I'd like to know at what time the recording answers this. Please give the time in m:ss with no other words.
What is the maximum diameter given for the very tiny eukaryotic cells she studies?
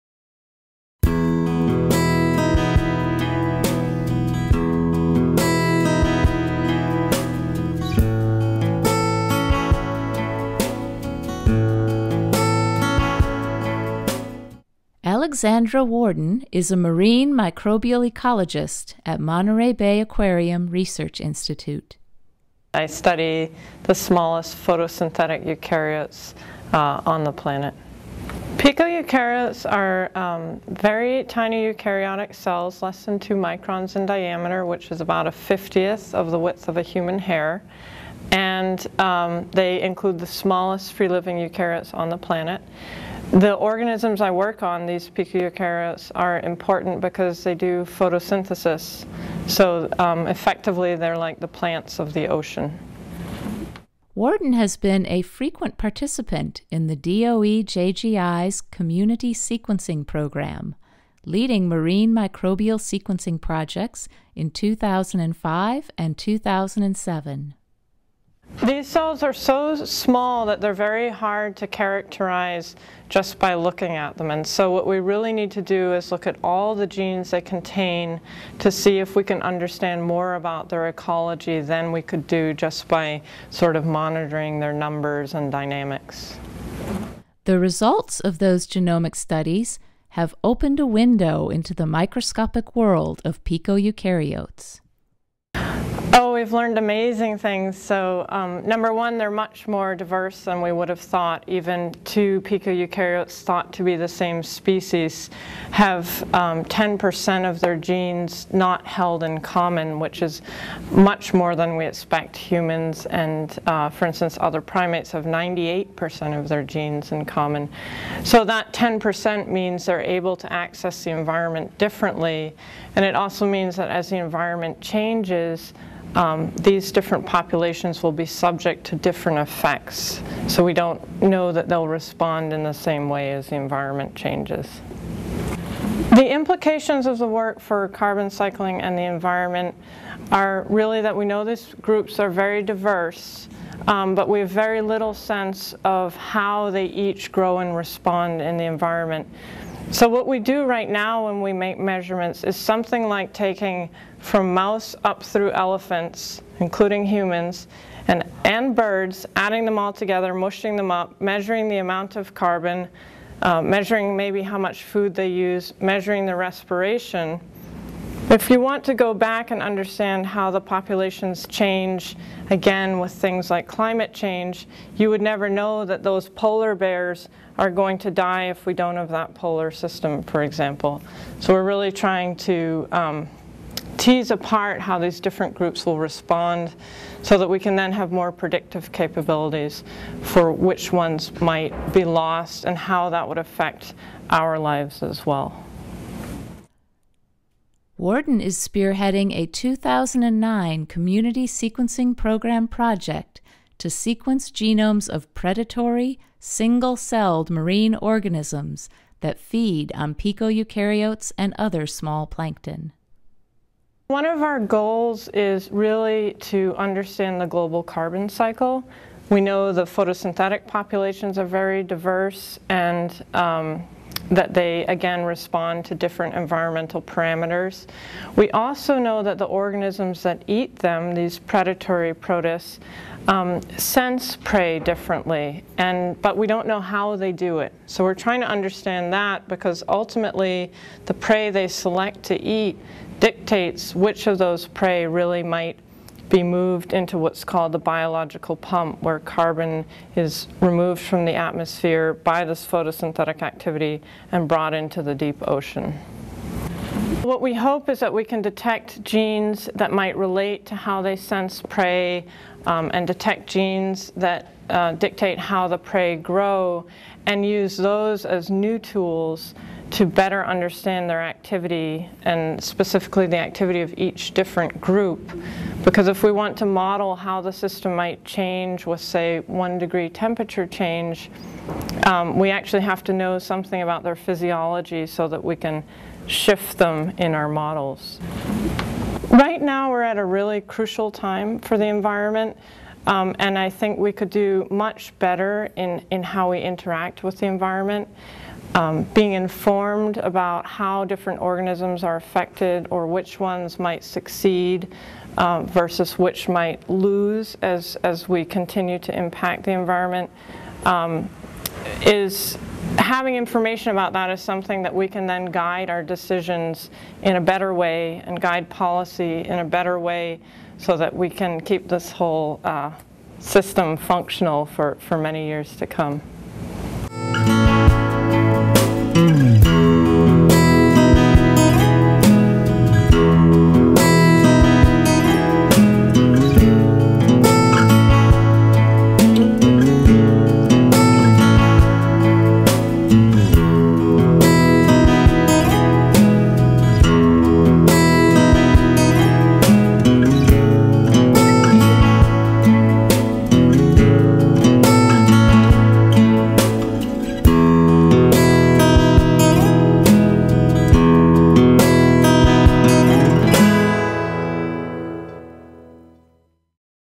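0:33.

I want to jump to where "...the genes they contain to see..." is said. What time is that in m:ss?
1:16.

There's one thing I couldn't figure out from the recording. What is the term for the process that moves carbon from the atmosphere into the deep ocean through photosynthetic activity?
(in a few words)
biological pump.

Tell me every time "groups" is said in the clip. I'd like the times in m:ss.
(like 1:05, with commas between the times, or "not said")
2:21, 3:05, 4:34.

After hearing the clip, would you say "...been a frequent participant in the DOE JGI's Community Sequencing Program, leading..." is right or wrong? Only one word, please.
right.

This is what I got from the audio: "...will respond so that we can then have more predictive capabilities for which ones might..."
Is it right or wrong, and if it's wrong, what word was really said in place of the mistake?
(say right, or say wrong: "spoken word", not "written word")
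right.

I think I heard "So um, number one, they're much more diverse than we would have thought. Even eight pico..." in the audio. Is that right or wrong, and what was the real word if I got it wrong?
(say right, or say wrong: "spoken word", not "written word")
wrong: "two", not "eight".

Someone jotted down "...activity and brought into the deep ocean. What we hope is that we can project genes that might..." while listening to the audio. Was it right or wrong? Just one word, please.
wrong.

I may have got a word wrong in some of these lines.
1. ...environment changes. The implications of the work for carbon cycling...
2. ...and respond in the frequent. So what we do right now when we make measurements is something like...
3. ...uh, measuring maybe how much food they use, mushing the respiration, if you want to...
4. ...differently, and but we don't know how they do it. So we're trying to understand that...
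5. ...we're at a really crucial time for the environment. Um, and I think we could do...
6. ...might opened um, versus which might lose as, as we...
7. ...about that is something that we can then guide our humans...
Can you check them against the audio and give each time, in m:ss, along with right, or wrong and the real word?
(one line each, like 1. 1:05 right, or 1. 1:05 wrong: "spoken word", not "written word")
1. 2:13 right
2. 2:27 wrong: "environment", not "frequent"
3. 2:43 wrong: "measuring", not "mushing"
4. 3:54 right
5. 4:49 right
6. 5:03 wrong: "succeed", not "opened"
7. 5:13 wrong: "decisions", not "humans".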